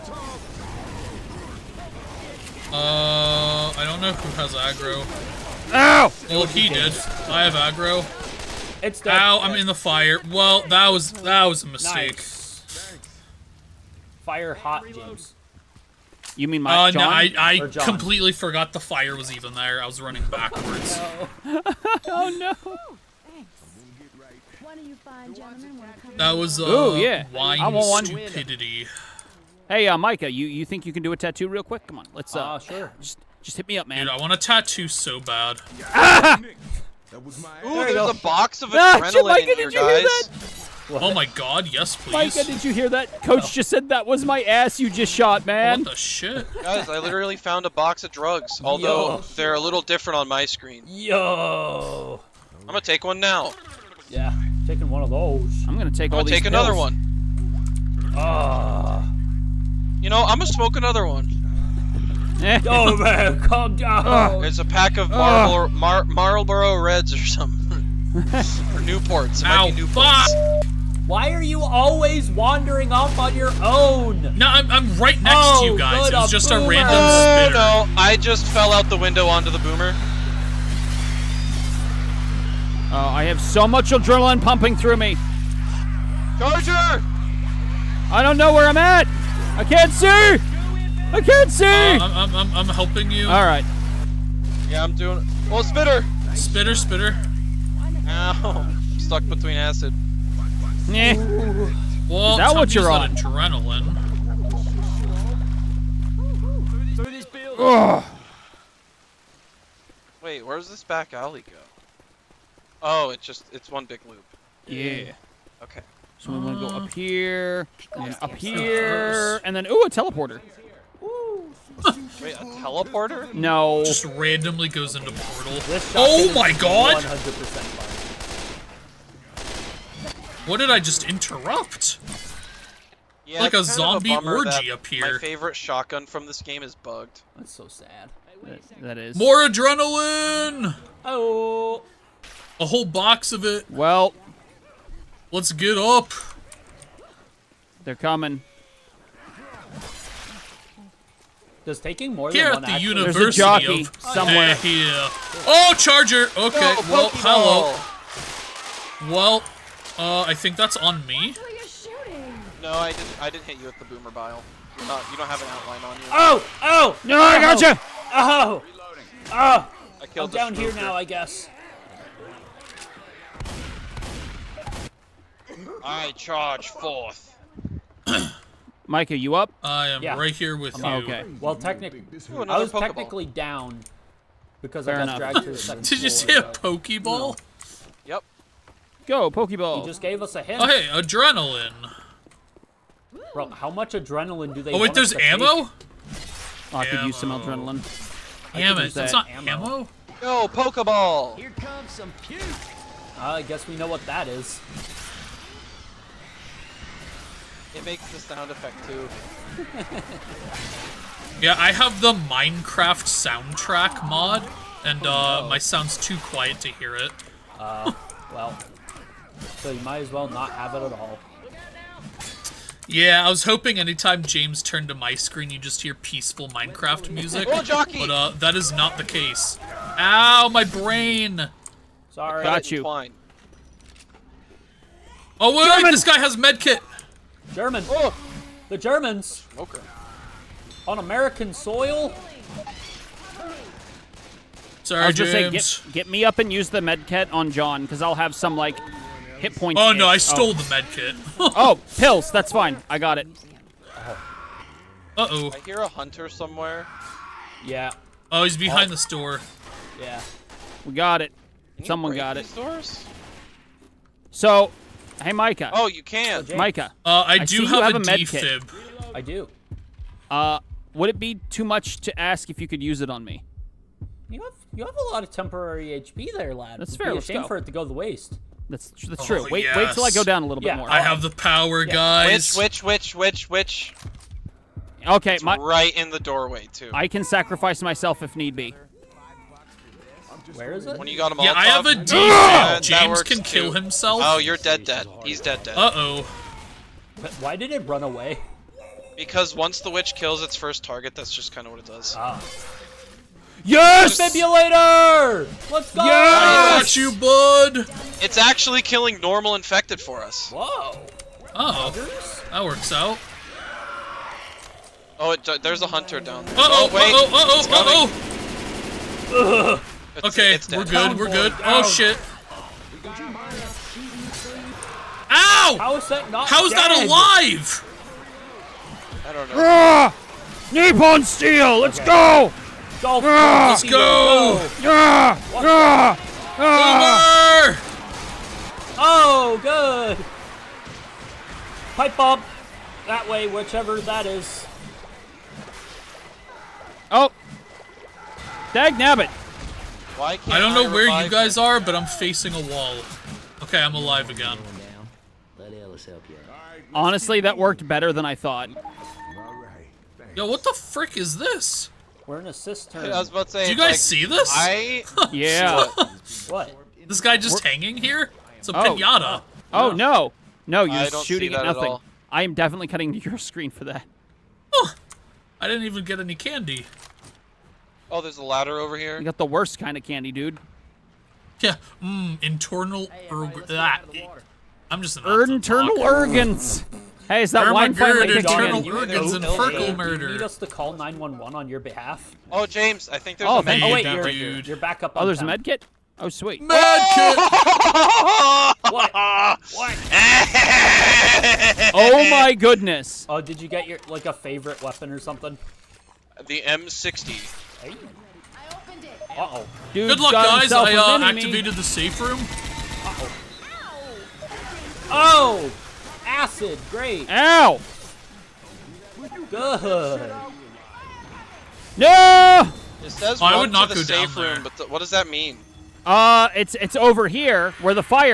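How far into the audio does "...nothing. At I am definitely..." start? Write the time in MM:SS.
06:11.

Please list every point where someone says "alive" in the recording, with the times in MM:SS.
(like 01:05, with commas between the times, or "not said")
05:27, 05:53.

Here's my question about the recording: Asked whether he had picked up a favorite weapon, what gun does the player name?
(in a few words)
M60.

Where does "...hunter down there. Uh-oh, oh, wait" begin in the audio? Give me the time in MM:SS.
05:15.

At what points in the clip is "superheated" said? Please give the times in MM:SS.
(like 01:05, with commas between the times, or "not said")
not said.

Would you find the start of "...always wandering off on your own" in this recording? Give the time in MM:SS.
01:11.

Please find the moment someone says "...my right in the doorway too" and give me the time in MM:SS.
04:45.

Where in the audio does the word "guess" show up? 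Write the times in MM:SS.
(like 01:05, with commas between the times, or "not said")
02:51, 03:23.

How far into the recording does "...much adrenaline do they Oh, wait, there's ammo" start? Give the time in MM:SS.
03:13.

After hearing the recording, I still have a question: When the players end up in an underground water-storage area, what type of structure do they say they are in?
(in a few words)
A cistern.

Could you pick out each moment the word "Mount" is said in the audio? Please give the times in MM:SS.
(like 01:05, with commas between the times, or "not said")
not said.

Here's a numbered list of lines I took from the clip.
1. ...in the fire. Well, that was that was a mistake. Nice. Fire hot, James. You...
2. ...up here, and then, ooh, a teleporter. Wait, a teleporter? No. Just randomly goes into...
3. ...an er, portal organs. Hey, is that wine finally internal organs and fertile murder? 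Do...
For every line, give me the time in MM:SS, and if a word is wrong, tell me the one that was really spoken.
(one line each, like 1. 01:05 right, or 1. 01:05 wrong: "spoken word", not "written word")
1. 00:09 right
2. 01:58 right
3. 06:25 wrong: "internal", not "portal".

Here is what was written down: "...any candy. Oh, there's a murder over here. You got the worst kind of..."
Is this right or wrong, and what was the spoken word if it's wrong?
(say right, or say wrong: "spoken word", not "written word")
wrong: "ladder", not "murder".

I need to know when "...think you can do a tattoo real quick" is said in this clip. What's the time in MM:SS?
00:30.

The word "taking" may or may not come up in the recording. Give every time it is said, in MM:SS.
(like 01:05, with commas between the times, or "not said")
00:54, 02:31.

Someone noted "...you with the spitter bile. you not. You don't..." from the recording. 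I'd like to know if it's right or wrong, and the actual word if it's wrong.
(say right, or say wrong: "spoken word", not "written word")
wrong: "boomer", not "spitter".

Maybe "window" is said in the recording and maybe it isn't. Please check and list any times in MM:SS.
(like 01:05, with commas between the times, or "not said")
01:18.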